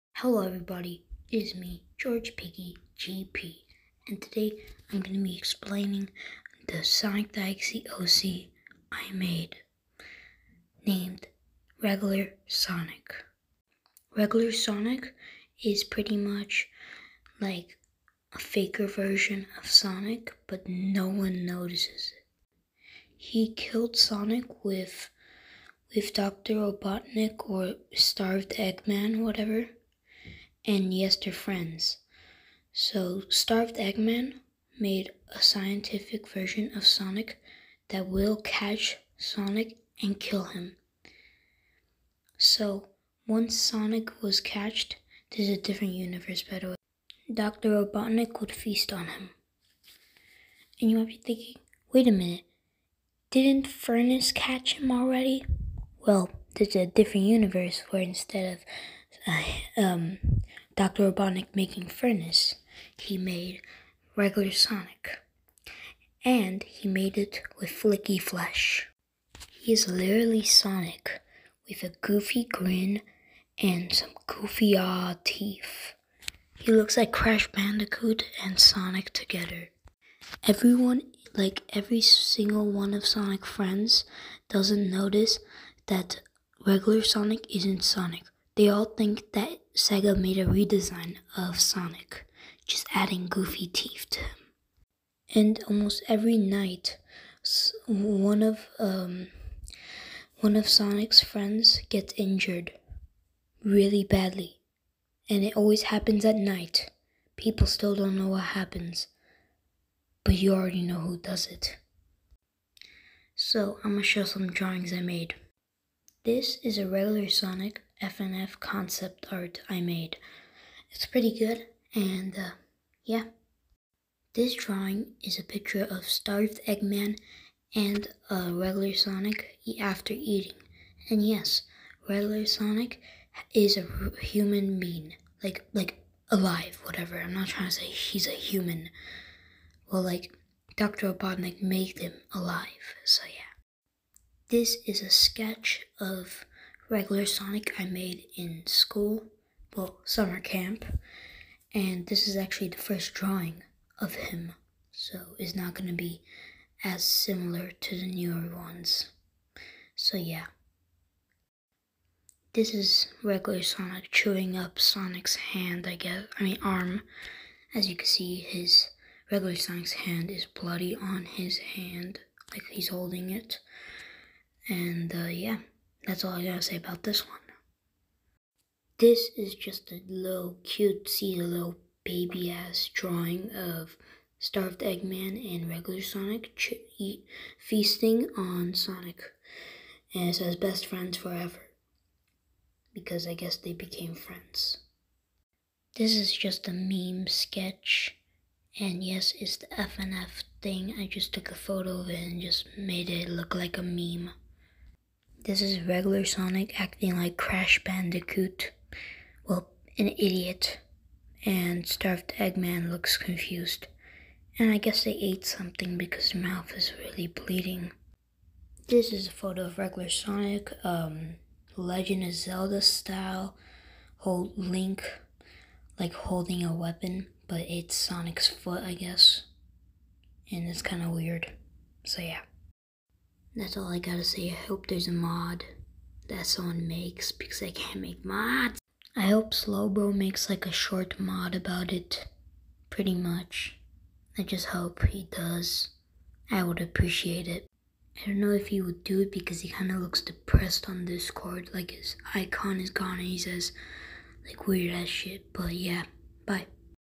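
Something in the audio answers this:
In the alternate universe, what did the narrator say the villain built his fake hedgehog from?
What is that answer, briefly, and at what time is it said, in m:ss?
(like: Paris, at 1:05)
Flicky flesh, at 1:07.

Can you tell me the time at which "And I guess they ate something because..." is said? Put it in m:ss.
3:34.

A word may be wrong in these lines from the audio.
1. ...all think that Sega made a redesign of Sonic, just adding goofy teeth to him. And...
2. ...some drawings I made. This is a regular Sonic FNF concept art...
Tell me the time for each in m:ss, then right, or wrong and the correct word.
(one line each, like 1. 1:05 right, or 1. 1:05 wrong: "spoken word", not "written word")
1. 1:28 right
2. 1:54 right.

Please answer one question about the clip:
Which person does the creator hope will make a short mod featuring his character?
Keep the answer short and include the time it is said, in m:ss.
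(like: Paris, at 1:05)
Slowbro, at 3:59.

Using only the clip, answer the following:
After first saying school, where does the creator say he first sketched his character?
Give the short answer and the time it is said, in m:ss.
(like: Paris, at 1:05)
Summer camp, at 2:30.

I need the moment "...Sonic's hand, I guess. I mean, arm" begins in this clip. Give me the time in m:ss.
2:44.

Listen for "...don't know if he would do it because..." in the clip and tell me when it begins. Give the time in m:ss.
4:08.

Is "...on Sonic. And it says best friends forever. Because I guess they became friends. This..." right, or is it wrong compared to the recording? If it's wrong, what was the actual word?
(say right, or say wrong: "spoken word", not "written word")
right.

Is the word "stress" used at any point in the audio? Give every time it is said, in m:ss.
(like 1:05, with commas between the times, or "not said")
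not said.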